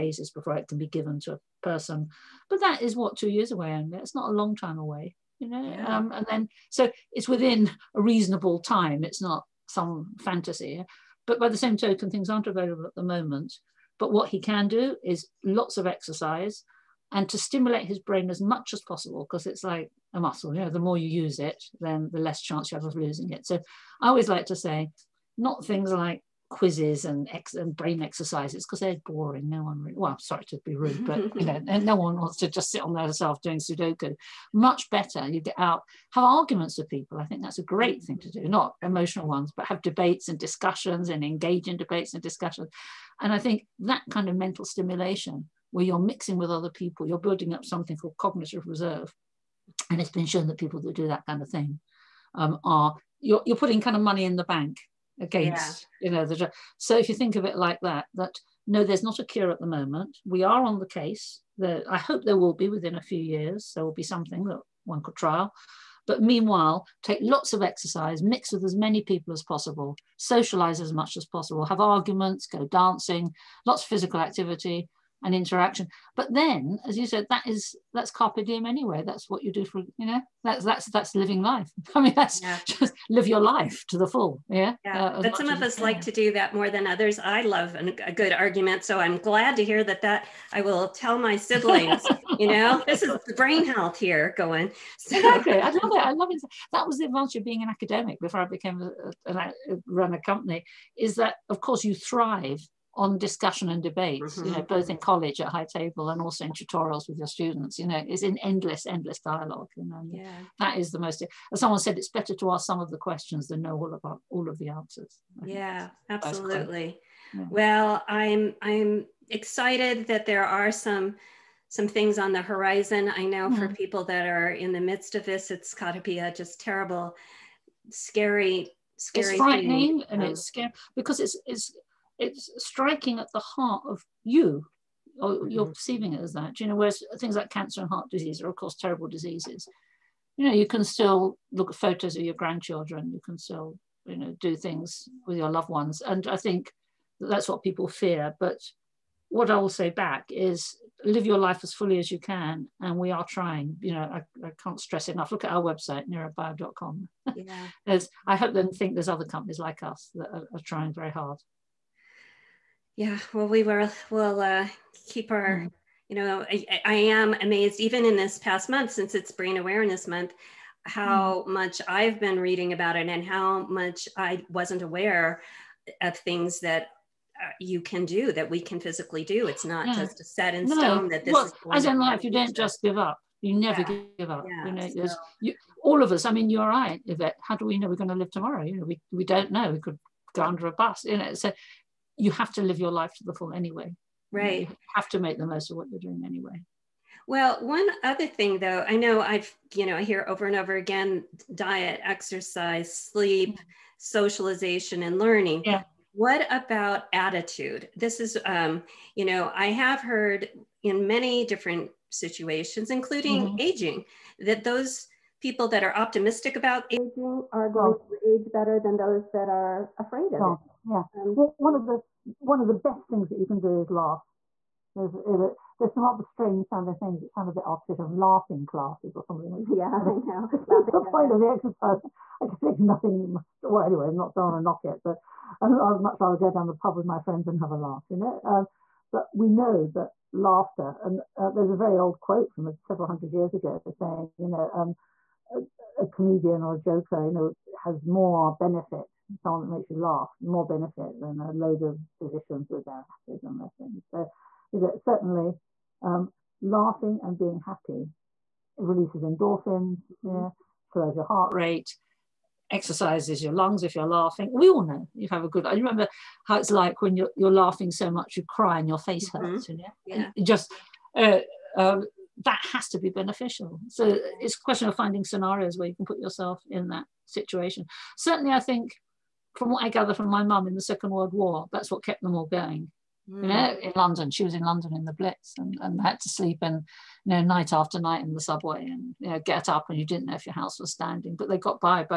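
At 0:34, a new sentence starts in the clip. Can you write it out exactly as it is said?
Much better, you get out, have arguments with people.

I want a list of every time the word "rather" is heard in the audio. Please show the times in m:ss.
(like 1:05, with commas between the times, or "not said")
3:46, 3:56.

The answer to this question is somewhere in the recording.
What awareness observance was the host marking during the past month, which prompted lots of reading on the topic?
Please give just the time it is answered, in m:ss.
2:49.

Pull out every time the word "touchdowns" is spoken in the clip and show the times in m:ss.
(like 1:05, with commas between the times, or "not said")
not said.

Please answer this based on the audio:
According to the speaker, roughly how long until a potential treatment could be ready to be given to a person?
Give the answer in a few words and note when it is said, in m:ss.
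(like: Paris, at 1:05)
two years, at 0:03.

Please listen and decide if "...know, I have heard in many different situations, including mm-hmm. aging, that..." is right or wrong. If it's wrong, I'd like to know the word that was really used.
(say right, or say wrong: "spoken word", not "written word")
right.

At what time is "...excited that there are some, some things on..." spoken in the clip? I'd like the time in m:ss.
1:59.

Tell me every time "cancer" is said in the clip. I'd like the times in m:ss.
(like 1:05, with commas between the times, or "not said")
2:17.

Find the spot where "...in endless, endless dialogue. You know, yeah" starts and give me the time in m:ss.
1:48.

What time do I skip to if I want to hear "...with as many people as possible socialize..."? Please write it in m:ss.
1:08.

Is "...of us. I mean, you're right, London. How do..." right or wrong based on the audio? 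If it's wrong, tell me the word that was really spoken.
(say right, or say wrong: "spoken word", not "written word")
wrong: "Yvette", not "London".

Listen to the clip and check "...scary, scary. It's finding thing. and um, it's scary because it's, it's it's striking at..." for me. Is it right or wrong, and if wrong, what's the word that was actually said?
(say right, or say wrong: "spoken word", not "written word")
wrong: "frightening", not "finding".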